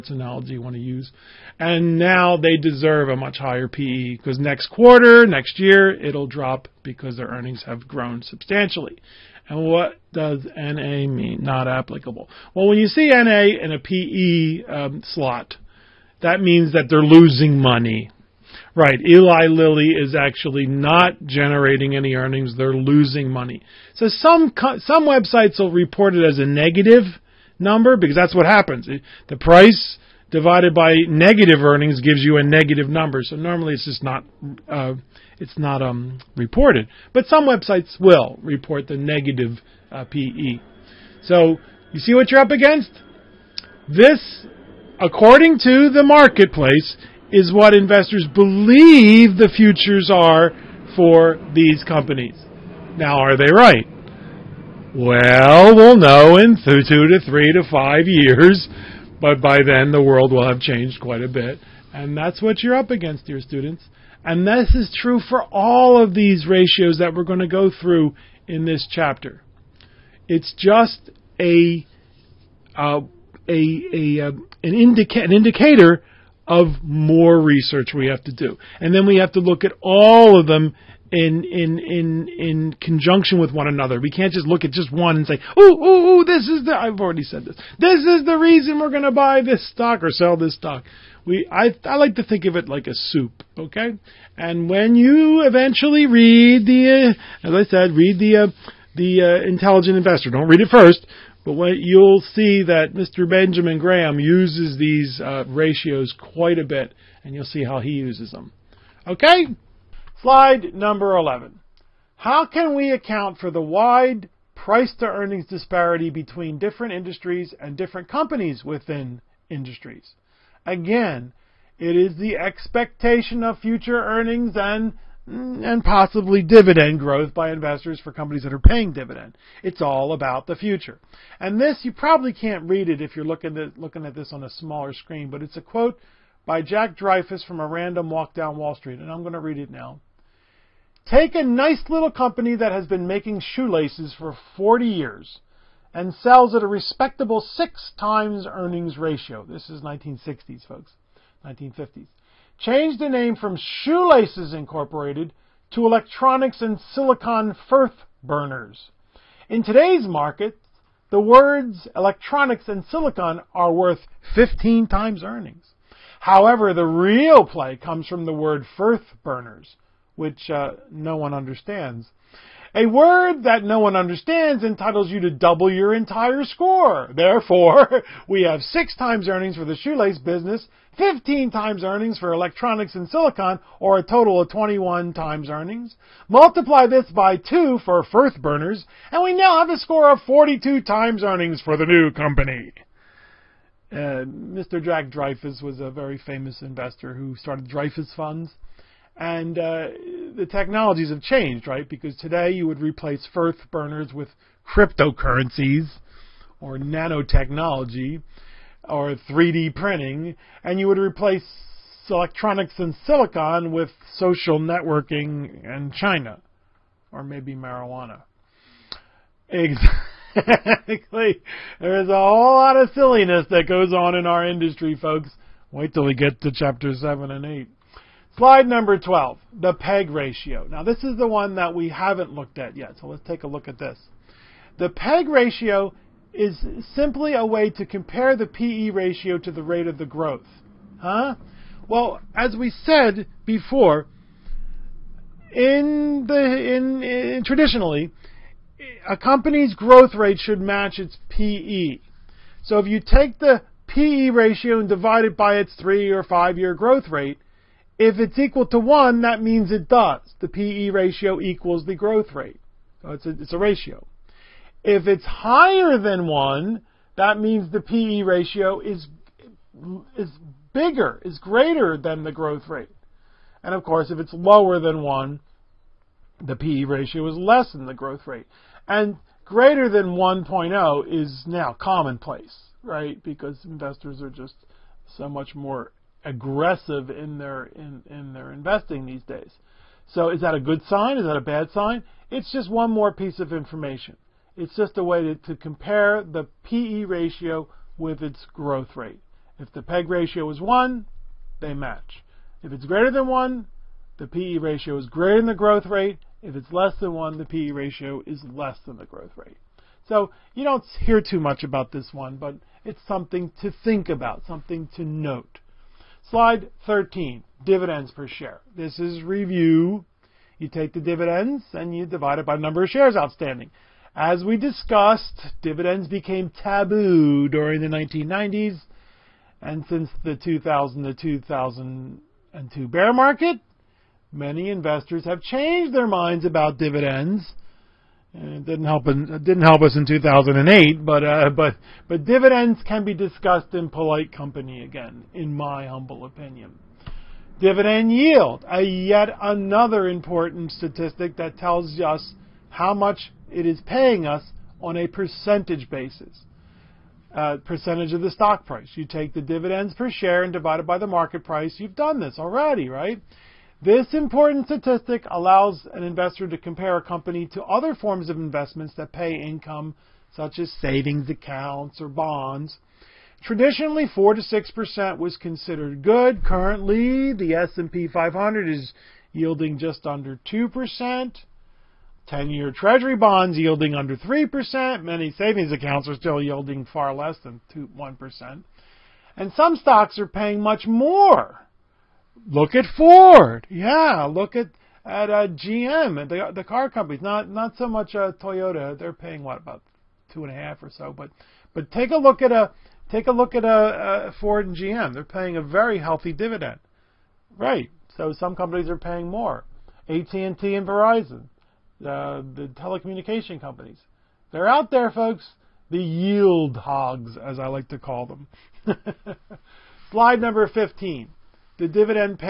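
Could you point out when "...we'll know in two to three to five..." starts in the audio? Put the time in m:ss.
0:55.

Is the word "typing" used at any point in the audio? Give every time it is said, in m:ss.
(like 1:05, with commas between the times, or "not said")
not said.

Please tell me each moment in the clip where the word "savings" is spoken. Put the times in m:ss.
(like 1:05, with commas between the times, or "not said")
6:10, 6:25.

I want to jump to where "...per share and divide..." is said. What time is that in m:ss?
5:59.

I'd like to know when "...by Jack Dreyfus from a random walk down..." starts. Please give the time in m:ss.
2:16.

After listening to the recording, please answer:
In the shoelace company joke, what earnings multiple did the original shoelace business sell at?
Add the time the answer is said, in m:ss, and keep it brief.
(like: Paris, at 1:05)
6, at 2:27.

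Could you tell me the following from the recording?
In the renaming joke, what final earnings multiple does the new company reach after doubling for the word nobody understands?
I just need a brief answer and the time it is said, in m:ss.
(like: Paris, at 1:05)
42, at 3:10.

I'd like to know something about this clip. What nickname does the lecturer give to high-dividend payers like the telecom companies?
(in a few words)
yield hogs.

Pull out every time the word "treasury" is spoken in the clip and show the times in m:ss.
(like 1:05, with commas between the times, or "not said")
6:22.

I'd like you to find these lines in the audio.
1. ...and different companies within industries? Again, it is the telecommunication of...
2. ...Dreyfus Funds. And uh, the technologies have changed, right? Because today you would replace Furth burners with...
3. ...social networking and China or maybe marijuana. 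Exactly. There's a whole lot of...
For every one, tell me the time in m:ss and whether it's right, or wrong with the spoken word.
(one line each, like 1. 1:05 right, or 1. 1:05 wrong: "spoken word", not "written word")
1. 1:57 wrong: "expectation", not "telecommunication"
2. 3:17 right
3. 3:34 right.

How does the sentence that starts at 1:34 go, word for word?
And when you eventually read the, uh, as I said, read the uh, the uh, intelligent investor.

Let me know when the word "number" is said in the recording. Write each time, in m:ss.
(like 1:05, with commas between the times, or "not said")
0:27, 0:32, 1:50, 3:48, 5:22, 7:00.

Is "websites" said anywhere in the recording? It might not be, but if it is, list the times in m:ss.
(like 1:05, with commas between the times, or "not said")
0:25, 0:37.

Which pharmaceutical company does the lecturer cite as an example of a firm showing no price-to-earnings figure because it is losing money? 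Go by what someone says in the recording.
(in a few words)
Eli Lilly.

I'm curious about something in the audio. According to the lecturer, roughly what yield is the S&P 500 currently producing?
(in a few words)
just under 2%.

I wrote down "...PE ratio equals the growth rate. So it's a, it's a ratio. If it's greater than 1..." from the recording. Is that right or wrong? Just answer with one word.
wrong.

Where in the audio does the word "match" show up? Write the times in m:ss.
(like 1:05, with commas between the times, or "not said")
4:10, 5:01.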